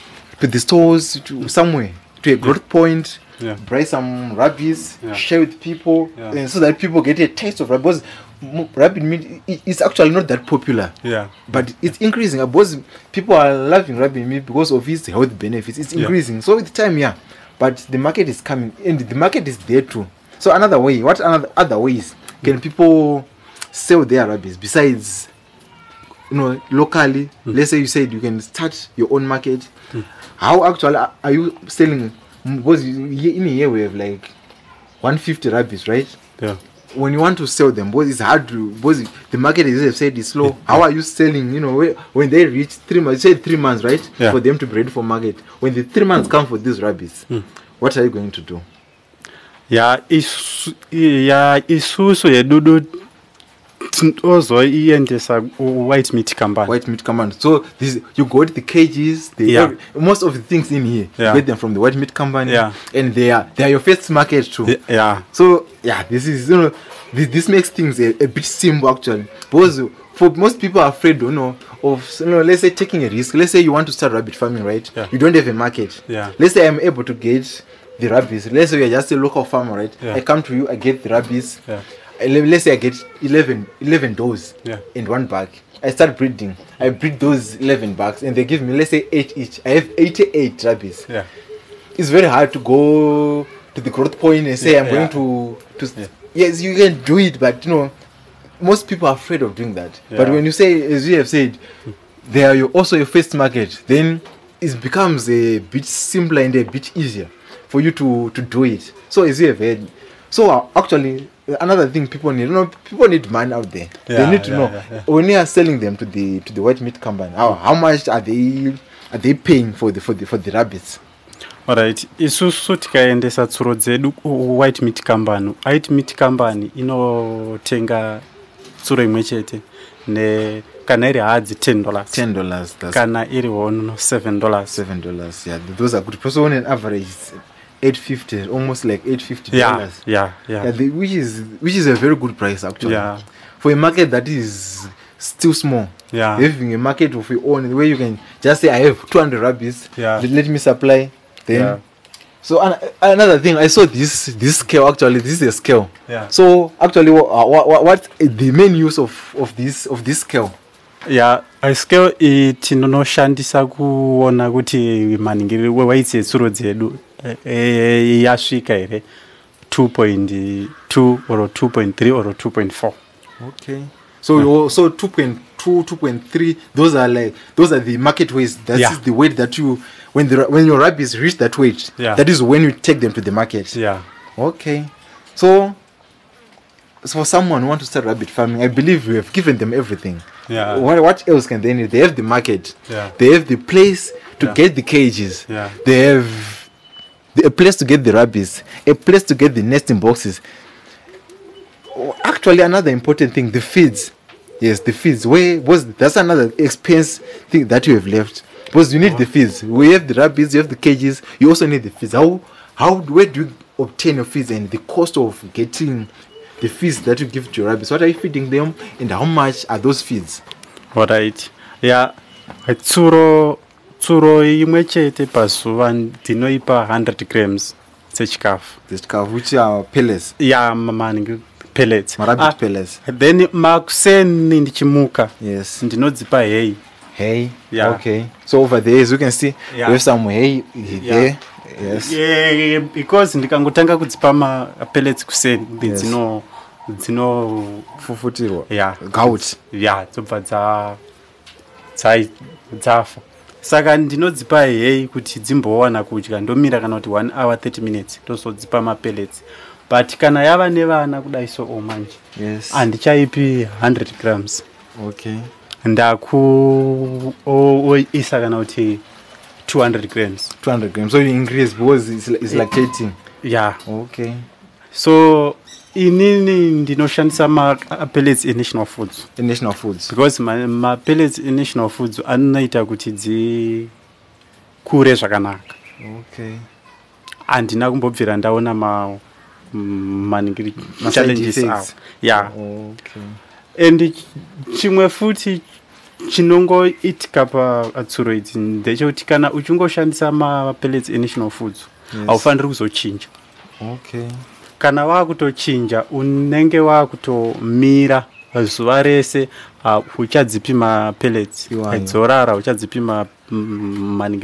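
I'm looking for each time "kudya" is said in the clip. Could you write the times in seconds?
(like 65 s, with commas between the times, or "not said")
256 s.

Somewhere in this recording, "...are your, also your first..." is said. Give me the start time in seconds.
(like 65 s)
102 s.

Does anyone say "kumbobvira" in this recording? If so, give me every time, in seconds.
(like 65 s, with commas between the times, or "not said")
287 s.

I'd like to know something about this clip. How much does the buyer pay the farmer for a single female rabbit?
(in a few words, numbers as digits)
$10.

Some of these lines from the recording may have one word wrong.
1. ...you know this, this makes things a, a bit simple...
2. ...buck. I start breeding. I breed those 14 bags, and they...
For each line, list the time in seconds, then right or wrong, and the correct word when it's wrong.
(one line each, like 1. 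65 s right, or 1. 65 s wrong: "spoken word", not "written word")
1. 66 s right
2. 85 s wrong: "11", not "14".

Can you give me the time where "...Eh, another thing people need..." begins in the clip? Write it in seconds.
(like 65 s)
111 s.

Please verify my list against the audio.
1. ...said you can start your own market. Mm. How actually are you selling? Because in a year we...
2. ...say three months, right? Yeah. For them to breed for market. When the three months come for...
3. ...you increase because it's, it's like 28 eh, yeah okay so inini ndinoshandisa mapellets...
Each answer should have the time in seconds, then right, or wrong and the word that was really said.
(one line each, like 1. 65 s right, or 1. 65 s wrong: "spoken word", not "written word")
1. 27 s right
2. 43 s right
3. 271 s wrong: "18", not "28".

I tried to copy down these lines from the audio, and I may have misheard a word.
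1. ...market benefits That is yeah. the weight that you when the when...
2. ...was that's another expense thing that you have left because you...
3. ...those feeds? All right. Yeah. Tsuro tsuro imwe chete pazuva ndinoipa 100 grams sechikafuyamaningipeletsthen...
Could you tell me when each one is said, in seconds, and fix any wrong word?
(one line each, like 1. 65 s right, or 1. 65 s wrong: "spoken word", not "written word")
1. 177 s wrong: "weights", not "benefits"
2. 205 s right
3. 219 s right.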